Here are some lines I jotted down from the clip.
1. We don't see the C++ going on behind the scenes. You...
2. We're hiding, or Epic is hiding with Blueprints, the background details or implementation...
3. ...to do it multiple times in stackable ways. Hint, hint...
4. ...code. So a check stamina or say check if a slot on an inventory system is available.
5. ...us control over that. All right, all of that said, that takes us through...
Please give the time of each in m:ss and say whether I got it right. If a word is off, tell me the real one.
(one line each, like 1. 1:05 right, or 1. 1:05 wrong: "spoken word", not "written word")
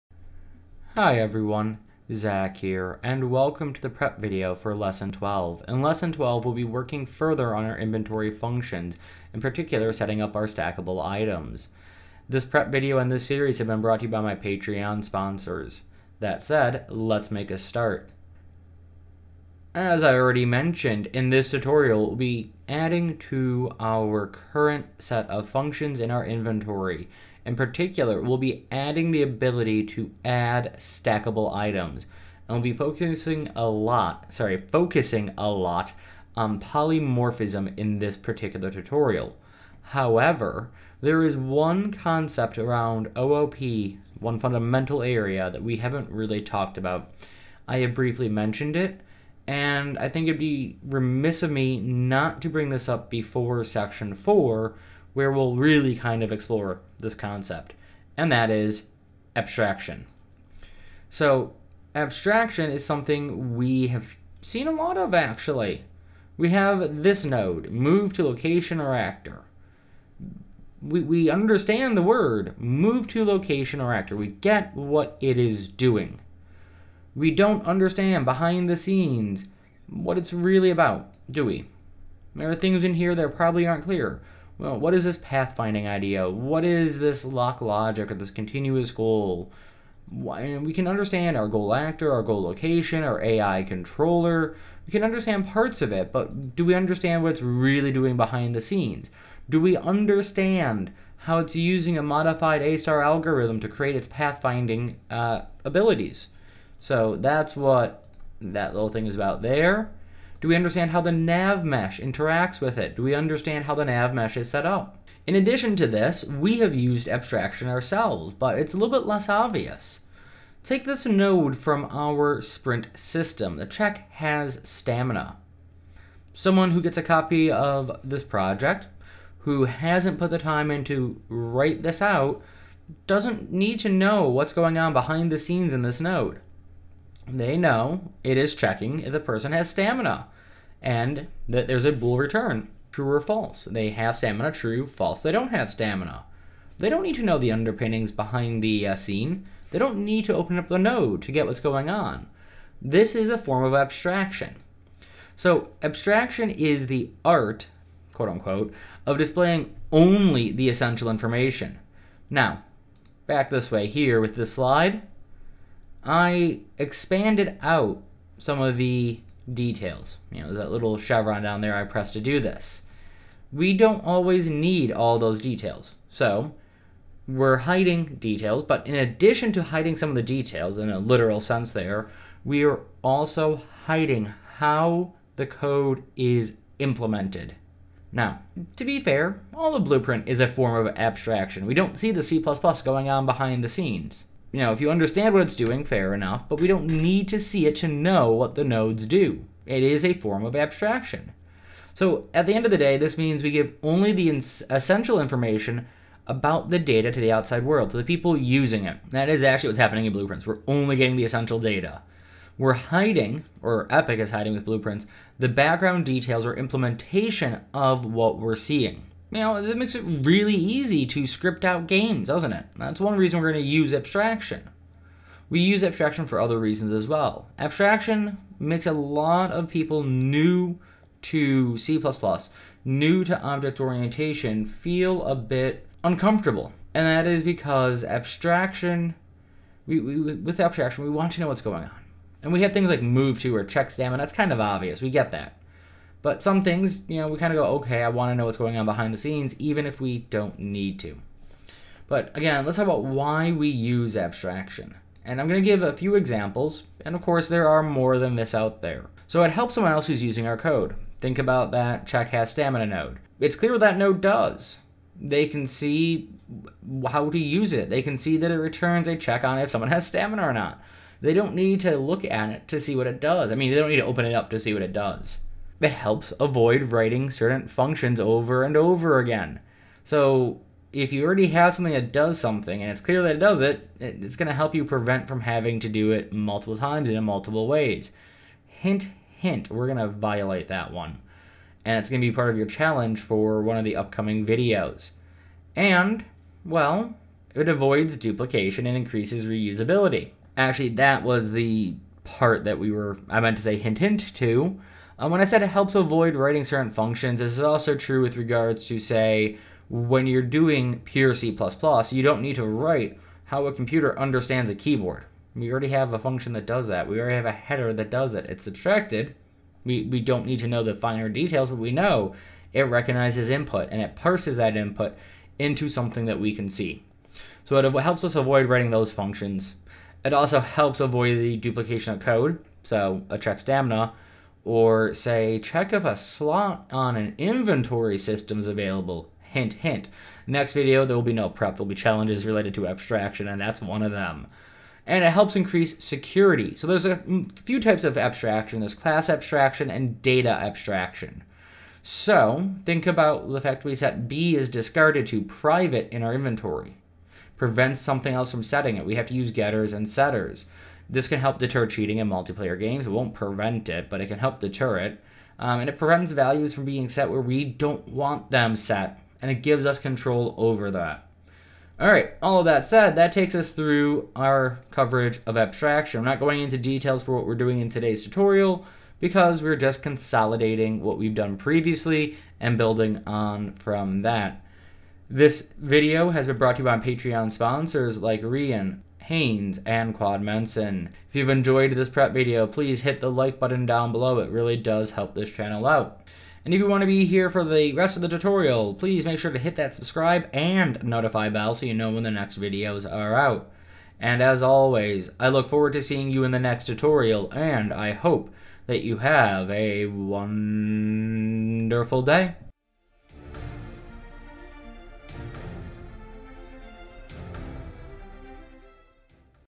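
1. 3:11 right
2. 3:32 right
3. 4:45 wrong: "multiple", not "stackable"
4. 5:32 right
5. 6:09 right.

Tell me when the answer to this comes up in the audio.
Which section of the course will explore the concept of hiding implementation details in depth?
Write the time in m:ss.
0:53.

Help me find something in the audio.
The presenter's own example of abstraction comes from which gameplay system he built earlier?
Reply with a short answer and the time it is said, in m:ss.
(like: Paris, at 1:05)
sprint system, at 2:02.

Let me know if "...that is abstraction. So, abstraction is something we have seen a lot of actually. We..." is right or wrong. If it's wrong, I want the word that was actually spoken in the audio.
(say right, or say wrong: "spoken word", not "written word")
right.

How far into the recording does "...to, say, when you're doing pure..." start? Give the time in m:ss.
5:08.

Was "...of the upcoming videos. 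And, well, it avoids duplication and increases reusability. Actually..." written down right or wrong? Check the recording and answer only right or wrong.
right.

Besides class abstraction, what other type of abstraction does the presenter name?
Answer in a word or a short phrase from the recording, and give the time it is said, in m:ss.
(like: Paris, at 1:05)
data abstraction, at 5:50.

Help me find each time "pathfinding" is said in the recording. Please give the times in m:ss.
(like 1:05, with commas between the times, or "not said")
1:25, 1:44.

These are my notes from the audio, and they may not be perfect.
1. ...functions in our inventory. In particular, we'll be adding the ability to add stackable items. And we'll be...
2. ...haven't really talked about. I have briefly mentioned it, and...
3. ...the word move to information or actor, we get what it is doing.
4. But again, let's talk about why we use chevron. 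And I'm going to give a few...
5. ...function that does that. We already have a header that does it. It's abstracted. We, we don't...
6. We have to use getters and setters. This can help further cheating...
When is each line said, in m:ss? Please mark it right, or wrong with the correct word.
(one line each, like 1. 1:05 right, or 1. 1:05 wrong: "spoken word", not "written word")
1. 0:25 right
2. 0:45 right
3. 1:11 wrong: "location", not "information"
4. 4:12 wrong: "abstraction", not "chevron"
5. 5:16 right
6. 5:59 wrong: "deter", not "further".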